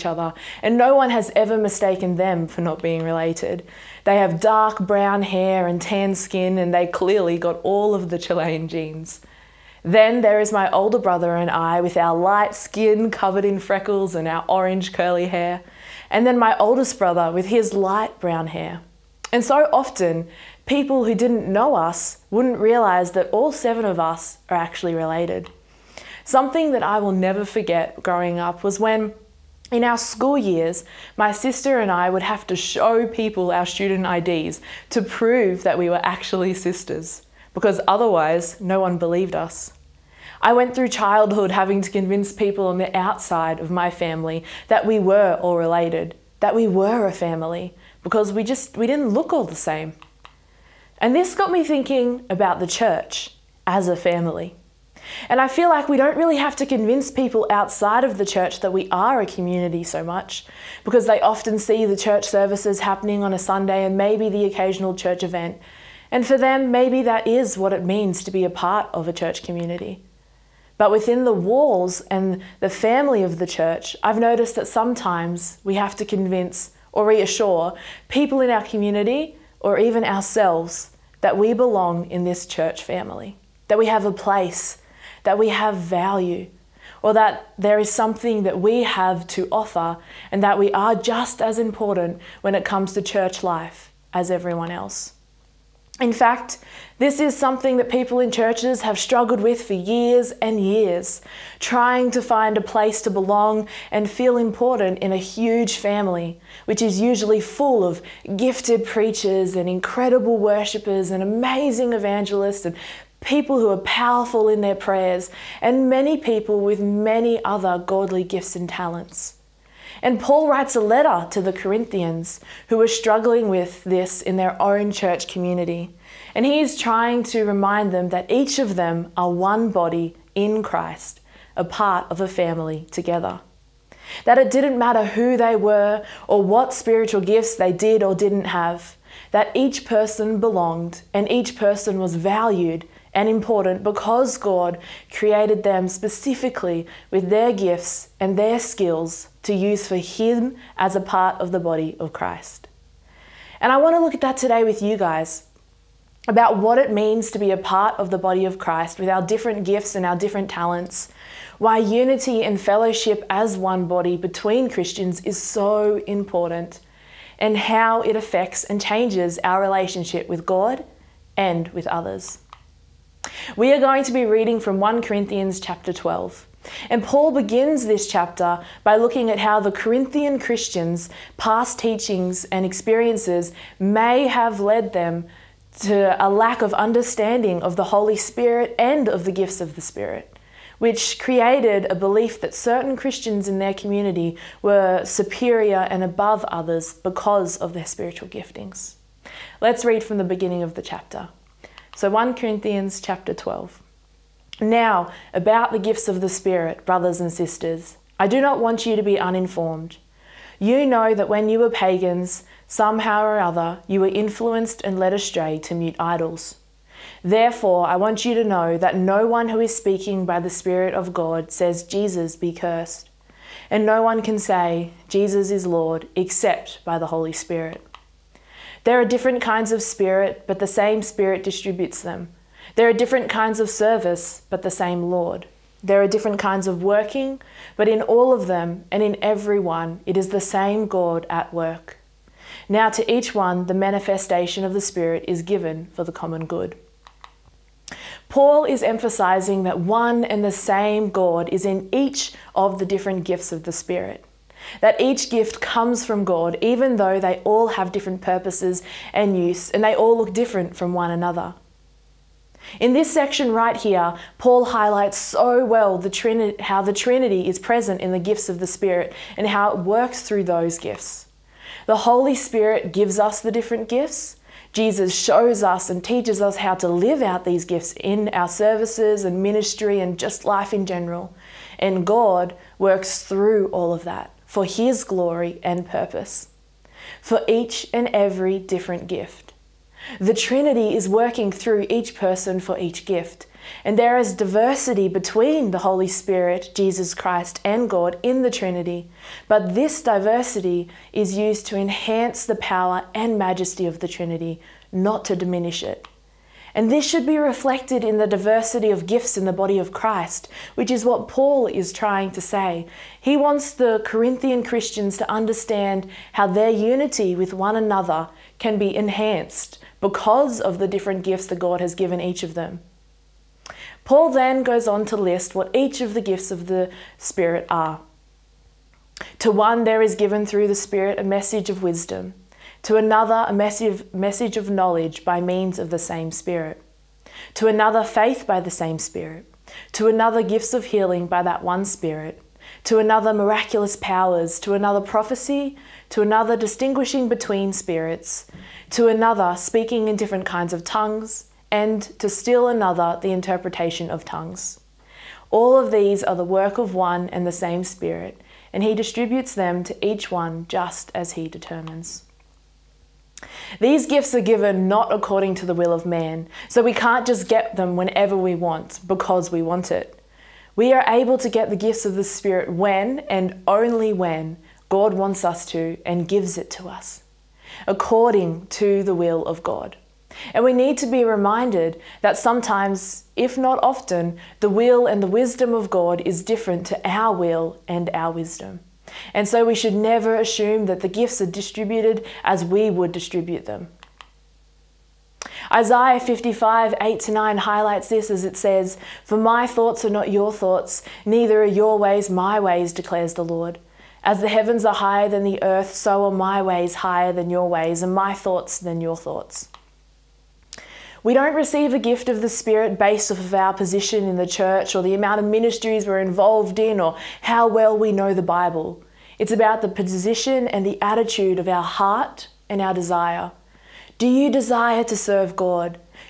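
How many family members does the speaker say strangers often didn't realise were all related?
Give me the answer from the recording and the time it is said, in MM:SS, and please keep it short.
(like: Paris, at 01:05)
7, at 00:23.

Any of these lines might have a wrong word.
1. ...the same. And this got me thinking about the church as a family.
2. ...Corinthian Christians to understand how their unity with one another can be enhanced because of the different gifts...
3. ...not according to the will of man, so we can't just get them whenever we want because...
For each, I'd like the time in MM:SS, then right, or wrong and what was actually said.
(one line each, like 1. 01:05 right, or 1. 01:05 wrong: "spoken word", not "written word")
1. 00:49 right
2. 05:14 right
3. 06:04 right.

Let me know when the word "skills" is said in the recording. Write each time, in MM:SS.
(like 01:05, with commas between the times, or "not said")
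02:28.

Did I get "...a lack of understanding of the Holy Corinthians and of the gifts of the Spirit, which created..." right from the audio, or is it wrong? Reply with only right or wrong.
wrong.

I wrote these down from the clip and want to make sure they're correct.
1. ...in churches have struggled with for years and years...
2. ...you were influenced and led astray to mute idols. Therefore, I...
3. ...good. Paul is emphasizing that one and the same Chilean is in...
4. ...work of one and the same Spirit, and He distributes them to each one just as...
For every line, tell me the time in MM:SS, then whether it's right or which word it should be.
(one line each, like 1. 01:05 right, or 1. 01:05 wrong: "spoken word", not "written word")
1. 01:38 right
2. 03:33 right
3. 04:06 wrong: "God", not "Chilean"
4. 05:56 right.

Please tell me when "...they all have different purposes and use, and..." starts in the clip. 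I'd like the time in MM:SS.
04:17.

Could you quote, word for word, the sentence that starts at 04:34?
Jesus shows us and teaches us how to live out these gifts in our services and ministry and just life in general.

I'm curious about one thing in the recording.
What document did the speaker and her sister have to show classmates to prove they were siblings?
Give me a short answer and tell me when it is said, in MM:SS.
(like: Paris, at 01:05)
student IDs, at 00:33.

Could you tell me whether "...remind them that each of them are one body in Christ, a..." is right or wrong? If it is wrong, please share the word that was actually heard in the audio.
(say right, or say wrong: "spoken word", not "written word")
right.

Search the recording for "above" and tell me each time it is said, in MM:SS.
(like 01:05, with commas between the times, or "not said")
03:16.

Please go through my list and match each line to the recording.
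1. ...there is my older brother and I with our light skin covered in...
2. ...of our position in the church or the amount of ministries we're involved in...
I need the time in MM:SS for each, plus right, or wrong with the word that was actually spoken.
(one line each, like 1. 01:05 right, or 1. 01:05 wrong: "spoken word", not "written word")
1. 00:10 right
2. 06:53 right.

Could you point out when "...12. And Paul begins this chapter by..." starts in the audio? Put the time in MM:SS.
02:55.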